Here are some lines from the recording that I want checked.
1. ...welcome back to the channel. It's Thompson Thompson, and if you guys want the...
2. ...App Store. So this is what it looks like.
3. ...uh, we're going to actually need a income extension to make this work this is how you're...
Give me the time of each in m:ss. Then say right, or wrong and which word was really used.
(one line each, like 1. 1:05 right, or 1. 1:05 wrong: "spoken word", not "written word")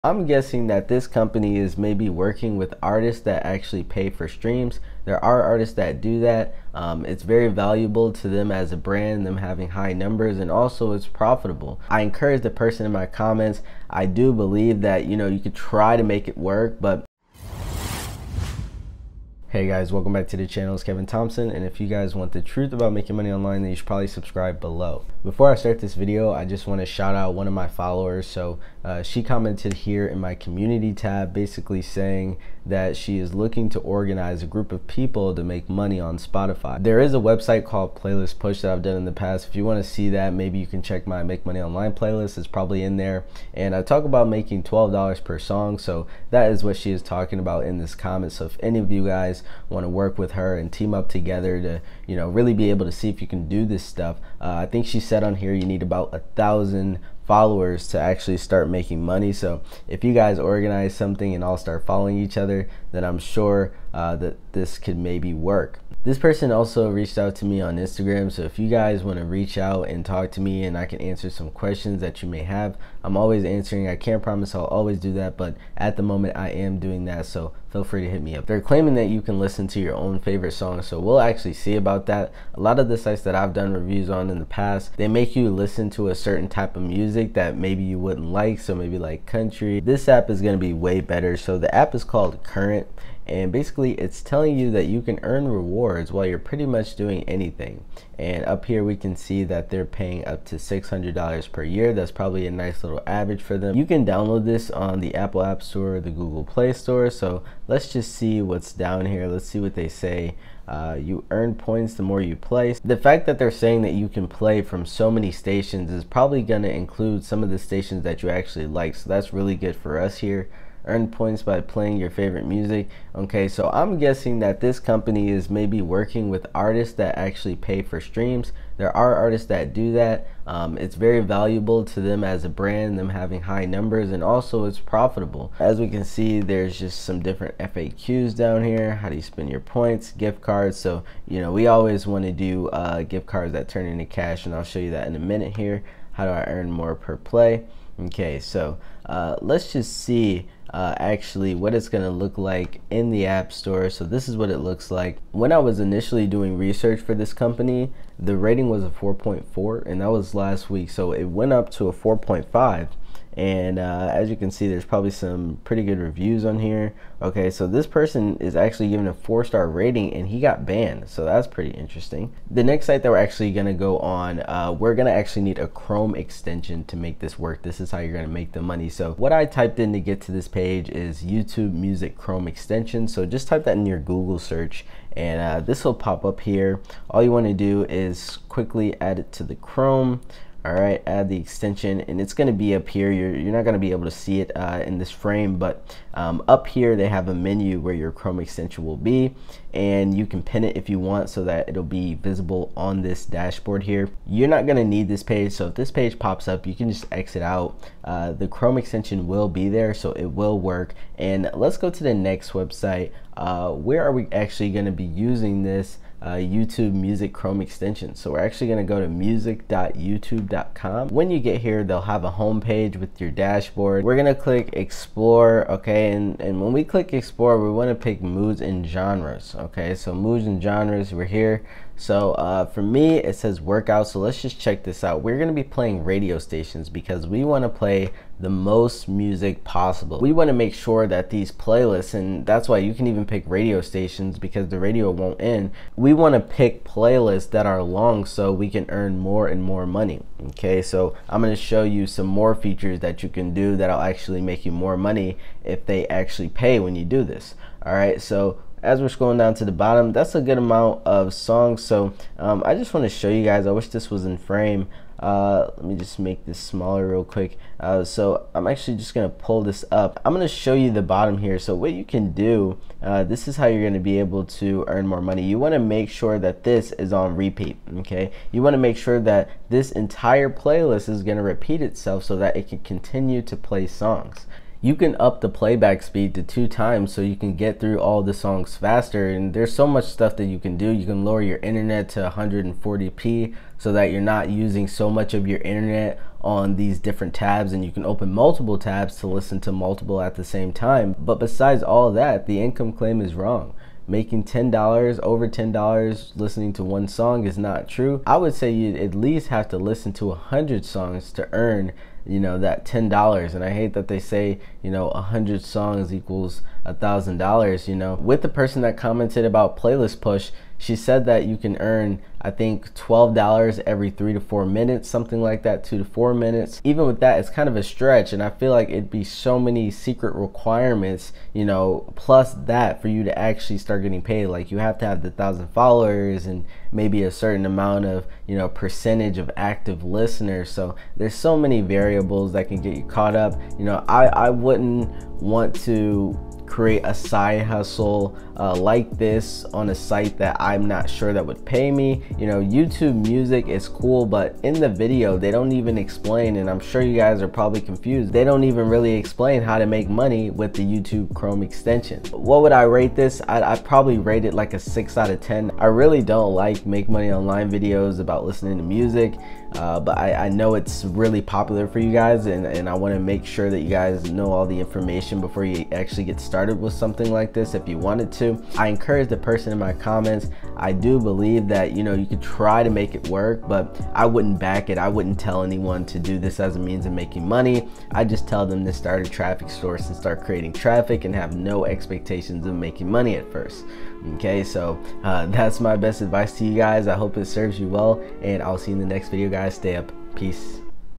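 1. 0:19 wrong: "Kevin", not "Thompson"
2. 2:33 right
3. 2:54 wrong: "chrome", not "income".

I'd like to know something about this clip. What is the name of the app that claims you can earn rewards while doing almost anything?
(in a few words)
Current.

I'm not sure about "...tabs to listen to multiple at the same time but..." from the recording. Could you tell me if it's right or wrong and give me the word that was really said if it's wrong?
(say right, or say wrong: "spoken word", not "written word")
right.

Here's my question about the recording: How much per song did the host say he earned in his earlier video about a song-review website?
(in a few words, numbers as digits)
$12.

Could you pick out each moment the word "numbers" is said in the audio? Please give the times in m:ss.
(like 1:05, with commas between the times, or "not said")
0:09, 2:13.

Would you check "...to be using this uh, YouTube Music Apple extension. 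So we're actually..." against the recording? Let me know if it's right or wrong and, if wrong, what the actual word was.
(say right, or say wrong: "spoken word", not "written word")
wrong: "Chrome", not "Apple".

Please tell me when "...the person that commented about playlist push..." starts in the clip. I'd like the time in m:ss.
5:18.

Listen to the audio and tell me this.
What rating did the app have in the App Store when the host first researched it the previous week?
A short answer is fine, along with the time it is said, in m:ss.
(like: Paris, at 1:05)
4.4, at 2:38.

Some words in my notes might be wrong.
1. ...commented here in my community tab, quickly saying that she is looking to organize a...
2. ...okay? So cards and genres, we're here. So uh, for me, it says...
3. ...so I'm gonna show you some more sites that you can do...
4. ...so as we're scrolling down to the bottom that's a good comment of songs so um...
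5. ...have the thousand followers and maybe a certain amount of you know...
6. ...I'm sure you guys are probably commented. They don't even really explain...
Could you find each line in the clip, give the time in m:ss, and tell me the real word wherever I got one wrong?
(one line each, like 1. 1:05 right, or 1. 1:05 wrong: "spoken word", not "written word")
1. 0:29 wrong: "basically", not "quickly"
2. 3:49 wrong: "moods", not "cards"
3. 4:10 wrong: "features", not "sites"
4. 4:18 wrong: "amount", not "comment"
5. 5:35 right
6. 5:56 wrong: "confused", not "commented".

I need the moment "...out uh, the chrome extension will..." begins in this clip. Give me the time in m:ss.
3:27.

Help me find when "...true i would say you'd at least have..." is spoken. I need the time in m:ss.
5:07.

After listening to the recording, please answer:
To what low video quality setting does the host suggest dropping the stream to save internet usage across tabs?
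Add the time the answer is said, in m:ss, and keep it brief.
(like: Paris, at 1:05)
140p, at 4:52.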